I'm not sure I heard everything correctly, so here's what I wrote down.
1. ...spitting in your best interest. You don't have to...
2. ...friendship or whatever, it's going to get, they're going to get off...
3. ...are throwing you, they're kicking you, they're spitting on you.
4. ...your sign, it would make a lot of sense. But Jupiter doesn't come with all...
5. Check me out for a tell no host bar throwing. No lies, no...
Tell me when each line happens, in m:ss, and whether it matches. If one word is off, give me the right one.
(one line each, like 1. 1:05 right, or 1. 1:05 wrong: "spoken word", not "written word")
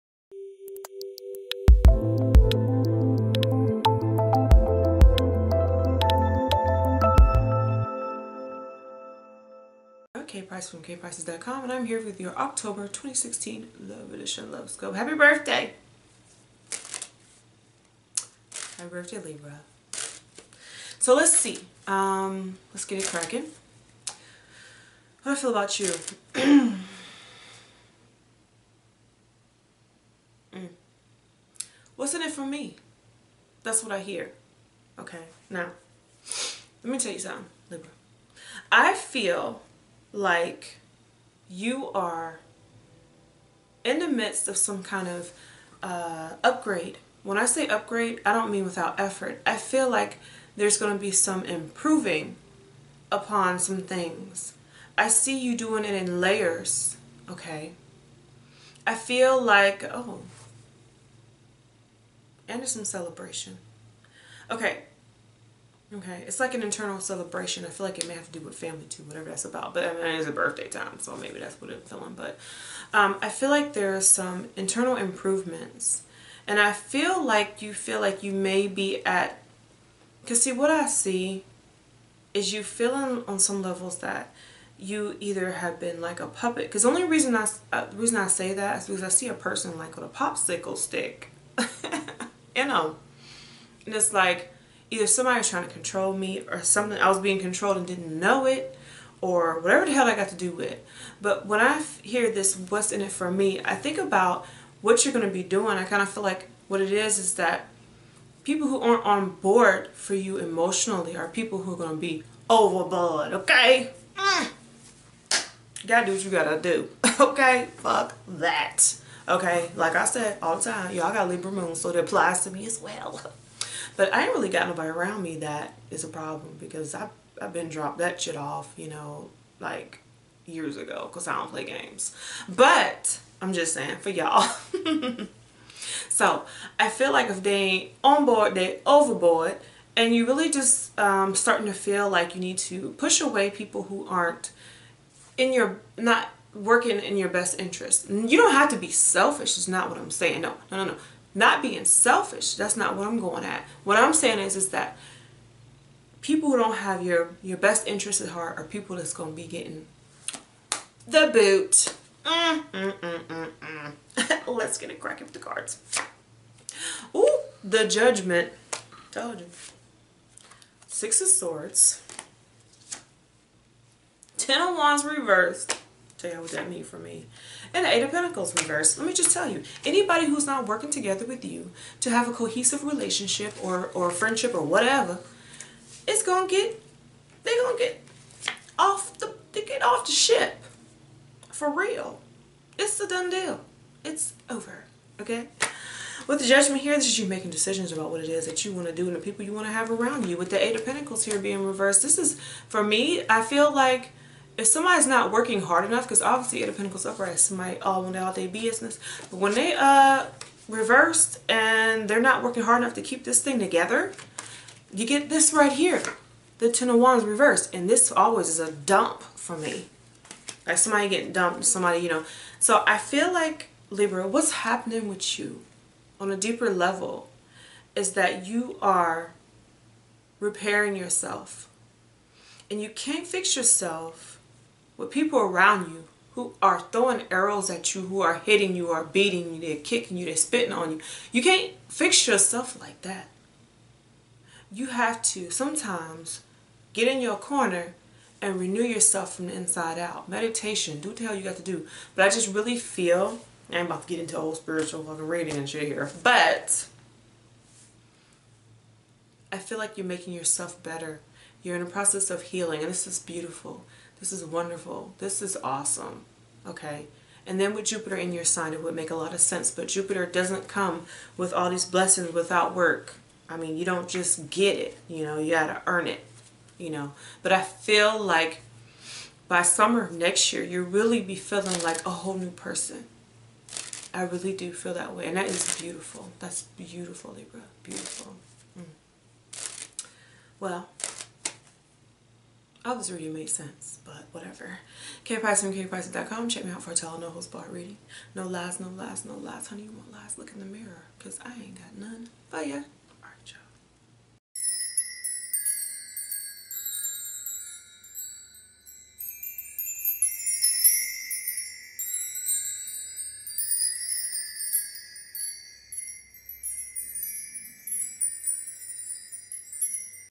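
1. 2:26 wrong: "working", not "spitting"
2. 3:04 right
3. 3:58 wrong: "beating", not "throwing"
4. 4:28 right
5. 4:56 wrong: "reading", not "throwing".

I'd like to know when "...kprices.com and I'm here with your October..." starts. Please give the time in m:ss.
0:10.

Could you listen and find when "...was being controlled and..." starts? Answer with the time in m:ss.
1:37.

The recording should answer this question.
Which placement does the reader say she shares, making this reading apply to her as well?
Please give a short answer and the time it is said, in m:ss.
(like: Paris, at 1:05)
Libra moon, at 2:01.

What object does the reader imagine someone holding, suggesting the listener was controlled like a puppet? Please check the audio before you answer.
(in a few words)
Popsicle stick.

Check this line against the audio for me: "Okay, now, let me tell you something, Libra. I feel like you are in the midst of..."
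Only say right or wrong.
right.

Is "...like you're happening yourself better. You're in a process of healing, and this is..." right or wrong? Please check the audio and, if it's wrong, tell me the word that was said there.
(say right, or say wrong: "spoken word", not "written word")
wrong: "making", not "happening".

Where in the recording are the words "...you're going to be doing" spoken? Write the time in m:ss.
1:45.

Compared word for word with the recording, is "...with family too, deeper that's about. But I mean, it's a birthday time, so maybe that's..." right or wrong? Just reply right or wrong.
wrong.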